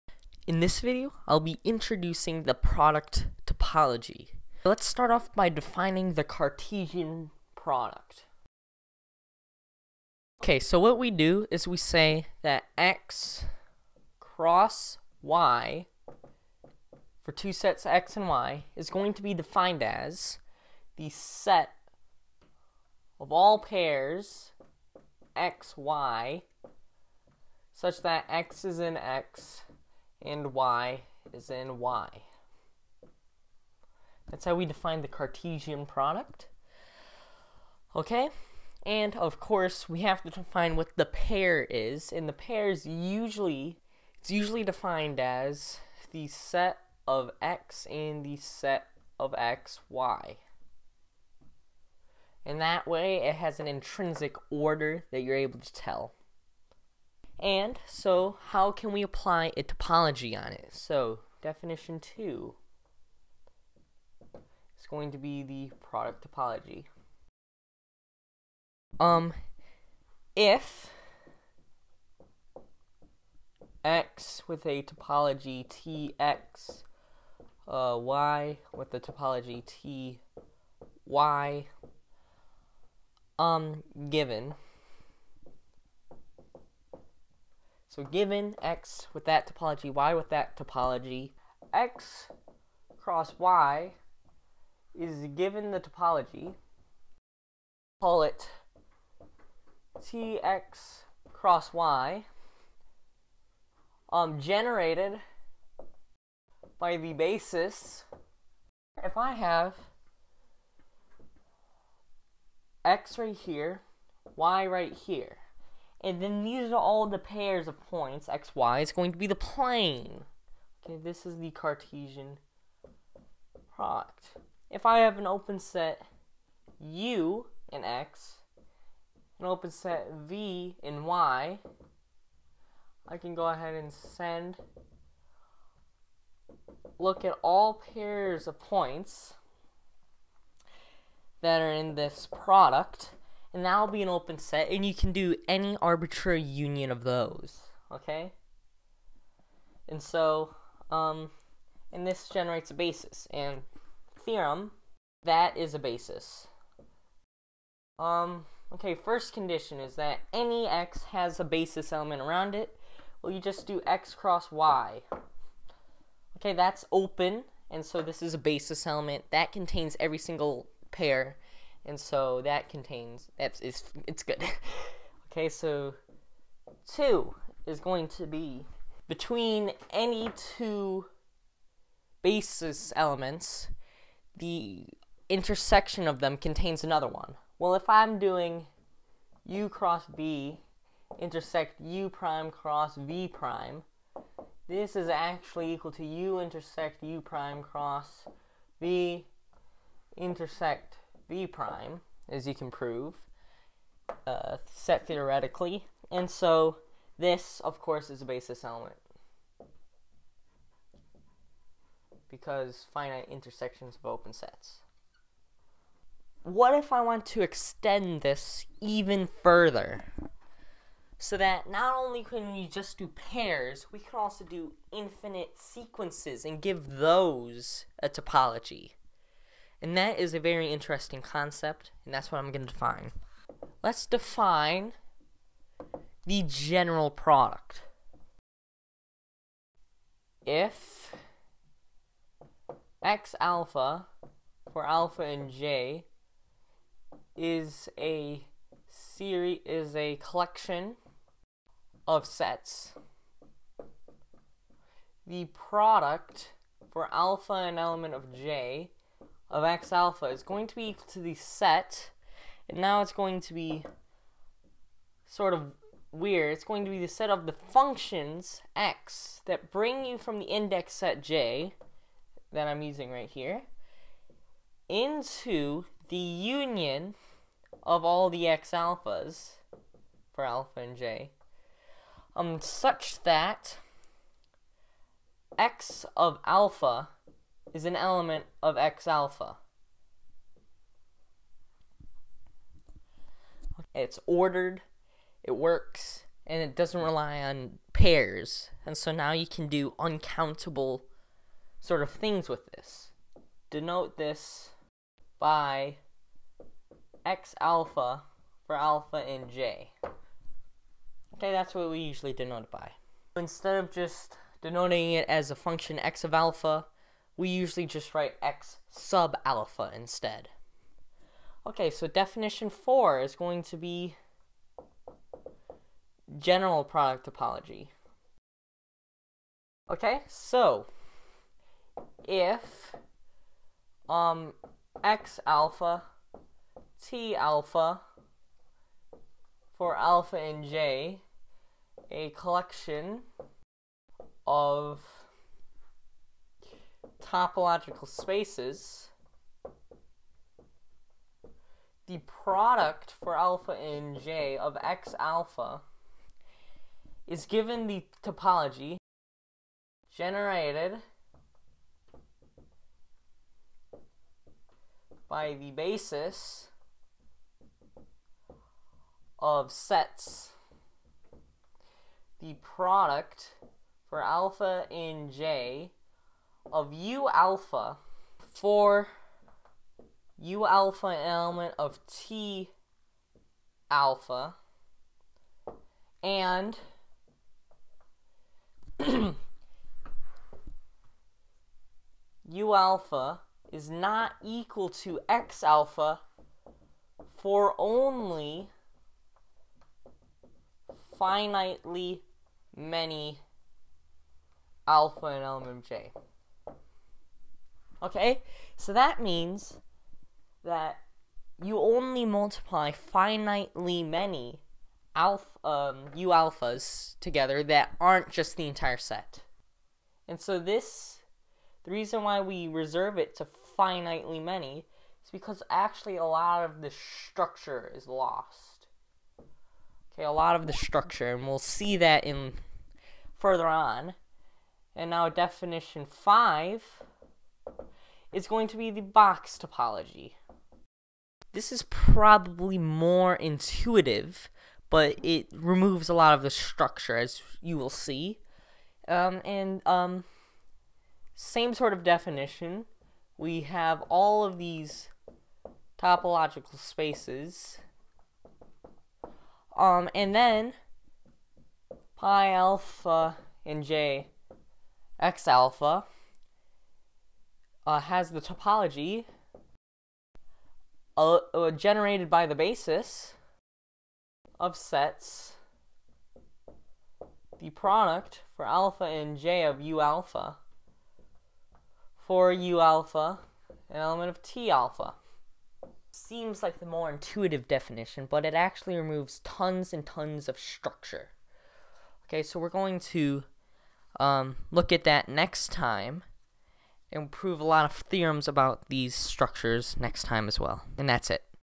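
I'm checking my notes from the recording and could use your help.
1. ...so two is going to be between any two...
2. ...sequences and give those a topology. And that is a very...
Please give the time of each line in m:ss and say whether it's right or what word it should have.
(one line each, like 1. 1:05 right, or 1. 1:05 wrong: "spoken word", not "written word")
1. 2:55 right
2. 3:45 right.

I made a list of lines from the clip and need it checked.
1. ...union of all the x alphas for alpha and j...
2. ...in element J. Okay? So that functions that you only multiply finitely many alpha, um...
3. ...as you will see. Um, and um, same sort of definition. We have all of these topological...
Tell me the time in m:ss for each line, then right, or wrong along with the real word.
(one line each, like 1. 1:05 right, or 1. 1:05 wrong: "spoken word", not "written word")
1. 4:36 right
2. 6:45 wrong: "means", not "functions"
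3. 7:27 right.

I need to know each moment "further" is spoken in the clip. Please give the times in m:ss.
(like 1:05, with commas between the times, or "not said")
3:39, 7:13.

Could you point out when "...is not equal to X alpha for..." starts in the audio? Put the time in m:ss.
6:33.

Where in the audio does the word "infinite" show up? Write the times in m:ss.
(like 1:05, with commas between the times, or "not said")
3:44.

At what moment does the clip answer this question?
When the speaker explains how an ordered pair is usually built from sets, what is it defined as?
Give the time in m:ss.
0:46.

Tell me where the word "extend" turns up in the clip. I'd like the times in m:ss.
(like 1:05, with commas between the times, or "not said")
3:37.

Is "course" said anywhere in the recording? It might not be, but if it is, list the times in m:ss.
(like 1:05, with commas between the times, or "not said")
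0:39, 3:27.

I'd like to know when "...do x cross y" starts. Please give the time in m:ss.
2:43.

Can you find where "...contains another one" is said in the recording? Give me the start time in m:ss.
3:06.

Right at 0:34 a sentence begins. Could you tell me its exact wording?
That's how we define the Cartesian product.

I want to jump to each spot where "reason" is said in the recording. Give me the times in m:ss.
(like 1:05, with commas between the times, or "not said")
7:01.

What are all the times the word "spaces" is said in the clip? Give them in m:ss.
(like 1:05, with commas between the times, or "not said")
5:48, 7:36.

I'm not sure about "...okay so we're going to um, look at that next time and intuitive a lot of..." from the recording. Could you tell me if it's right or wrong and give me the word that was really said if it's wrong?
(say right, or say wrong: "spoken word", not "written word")
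wrong: "prove", not "intuitive".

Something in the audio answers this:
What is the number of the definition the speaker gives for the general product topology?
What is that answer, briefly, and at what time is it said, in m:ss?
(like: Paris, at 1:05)
4, at 5:22.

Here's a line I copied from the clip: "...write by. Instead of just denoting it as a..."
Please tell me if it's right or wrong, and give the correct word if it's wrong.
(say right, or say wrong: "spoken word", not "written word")
wrong: "denote", not "write".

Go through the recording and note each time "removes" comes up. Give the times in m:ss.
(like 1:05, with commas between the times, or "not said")
7:25, 8:08.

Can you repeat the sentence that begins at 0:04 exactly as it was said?
Let's start off by defining the Cartesian product.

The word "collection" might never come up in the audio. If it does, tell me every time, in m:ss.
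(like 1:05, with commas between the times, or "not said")
4:10, 5:42.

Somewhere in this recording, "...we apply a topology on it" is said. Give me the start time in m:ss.
0:58.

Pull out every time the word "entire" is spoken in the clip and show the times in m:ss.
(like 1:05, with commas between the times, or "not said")
6:58.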